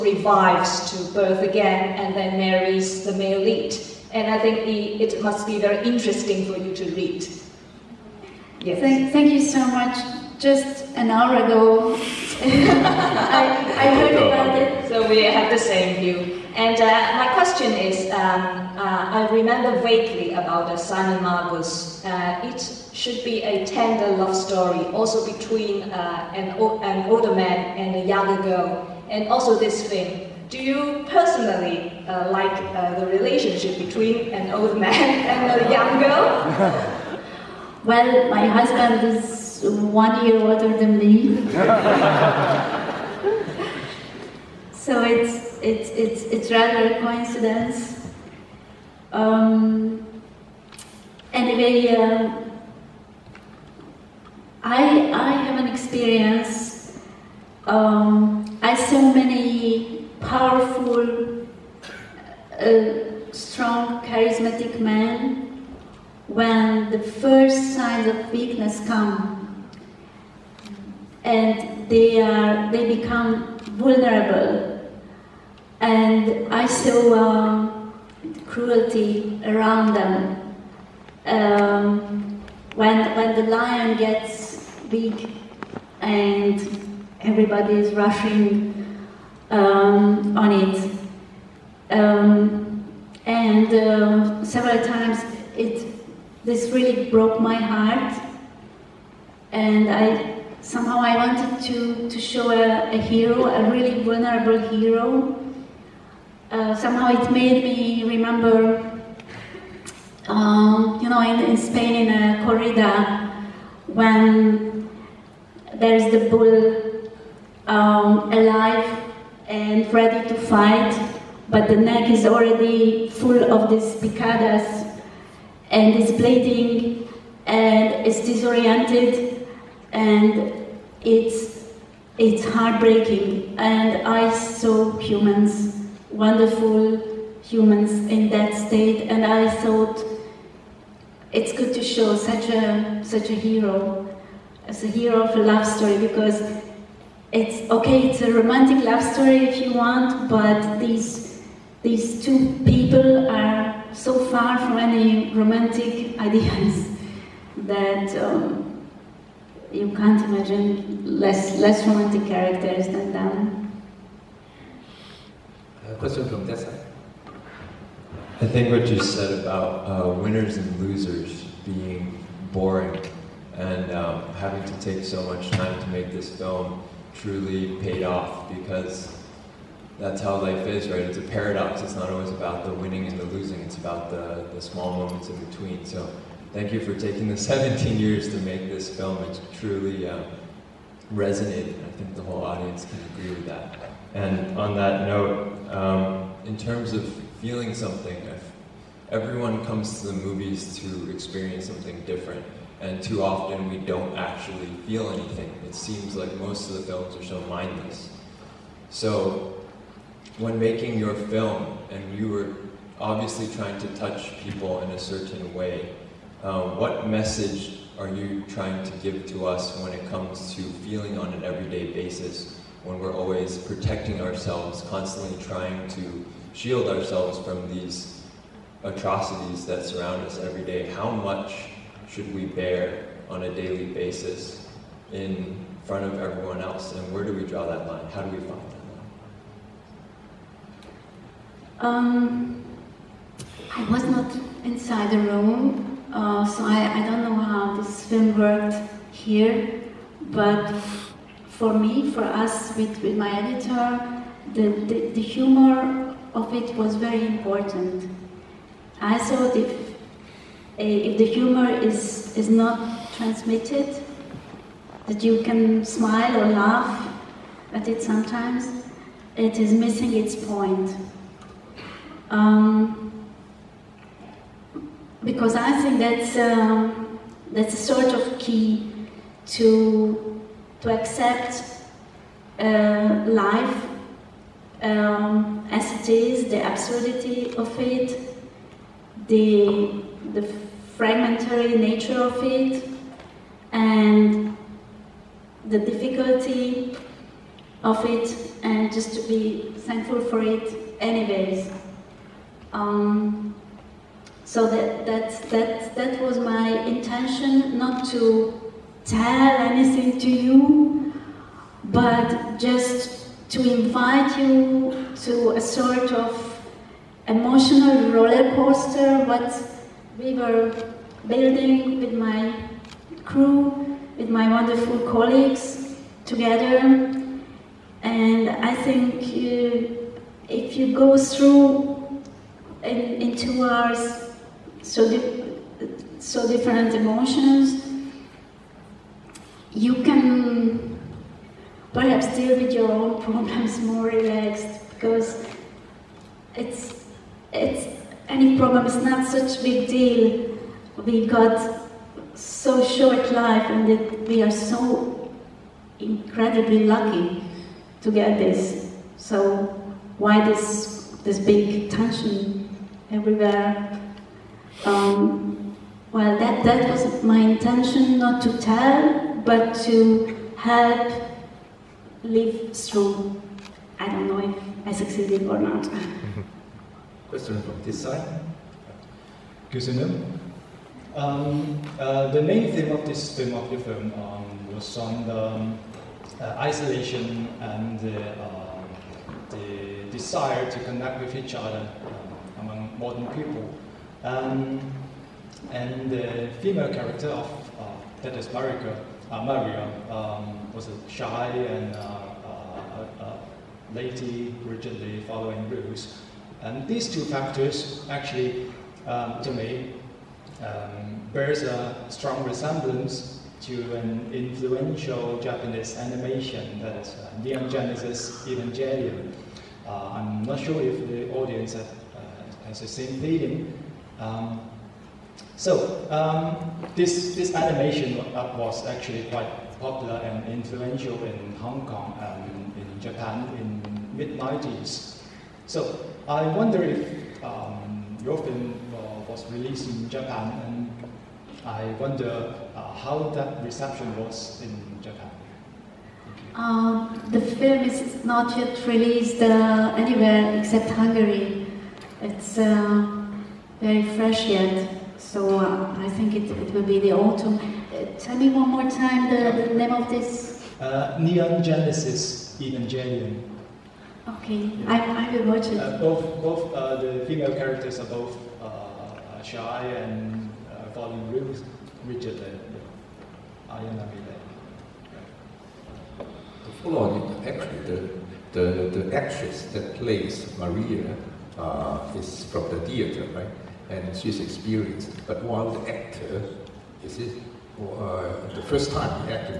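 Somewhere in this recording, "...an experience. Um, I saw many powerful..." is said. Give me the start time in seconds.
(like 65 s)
55 s.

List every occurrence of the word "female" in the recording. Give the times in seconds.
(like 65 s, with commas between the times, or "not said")
396 s, 467 s.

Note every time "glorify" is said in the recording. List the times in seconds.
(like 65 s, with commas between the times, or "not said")
not said.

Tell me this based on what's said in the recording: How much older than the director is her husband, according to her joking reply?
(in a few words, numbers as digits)
1 year.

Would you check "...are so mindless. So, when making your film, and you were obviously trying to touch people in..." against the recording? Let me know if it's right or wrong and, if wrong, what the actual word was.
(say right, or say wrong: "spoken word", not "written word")
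right.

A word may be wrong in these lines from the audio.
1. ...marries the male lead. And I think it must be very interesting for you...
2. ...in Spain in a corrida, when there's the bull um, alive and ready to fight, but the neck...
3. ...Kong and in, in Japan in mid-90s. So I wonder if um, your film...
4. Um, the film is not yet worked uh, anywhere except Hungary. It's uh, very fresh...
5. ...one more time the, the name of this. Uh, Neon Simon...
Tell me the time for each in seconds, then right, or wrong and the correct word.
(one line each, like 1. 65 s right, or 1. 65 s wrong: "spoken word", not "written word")
1. 2 s right
2. 111 s right
3. 431 s right
4. 446 s wrong: "released", not "worked"
5. 458 s wrong: "Genesis", not "Simon".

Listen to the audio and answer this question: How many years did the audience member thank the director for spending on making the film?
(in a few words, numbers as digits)
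17.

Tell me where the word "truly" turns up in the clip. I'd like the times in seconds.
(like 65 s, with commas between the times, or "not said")
177 s, 189 s.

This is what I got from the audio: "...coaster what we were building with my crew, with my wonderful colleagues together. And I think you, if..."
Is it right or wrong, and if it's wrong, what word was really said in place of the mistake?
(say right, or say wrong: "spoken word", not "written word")
right.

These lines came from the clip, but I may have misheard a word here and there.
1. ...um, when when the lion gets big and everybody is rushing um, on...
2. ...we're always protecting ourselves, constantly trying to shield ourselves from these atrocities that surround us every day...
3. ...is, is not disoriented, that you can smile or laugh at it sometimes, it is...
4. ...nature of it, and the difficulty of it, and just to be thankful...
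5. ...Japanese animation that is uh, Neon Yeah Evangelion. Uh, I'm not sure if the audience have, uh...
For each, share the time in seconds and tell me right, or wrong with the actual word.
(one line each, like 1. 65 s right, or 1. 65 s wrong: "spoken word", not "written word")
1. 81 s right
2. 222 s right
3. 261 s wrong: "transmitted", not "disoriented"
4. 291 s right
5. 415 s wrong: "Genesis", not "Yeah".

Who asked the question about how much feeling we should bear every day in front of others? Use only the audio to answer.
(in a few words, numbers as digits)
Tessa.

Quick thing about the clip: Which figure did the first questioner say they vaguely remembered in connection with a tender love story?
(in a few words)
Simon Magus.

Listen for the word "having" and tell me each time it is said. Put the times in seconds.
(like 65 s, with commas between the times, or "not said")
174 s.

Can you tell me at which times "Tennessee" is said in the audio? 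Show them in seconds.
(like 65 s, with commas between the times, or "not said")
not said.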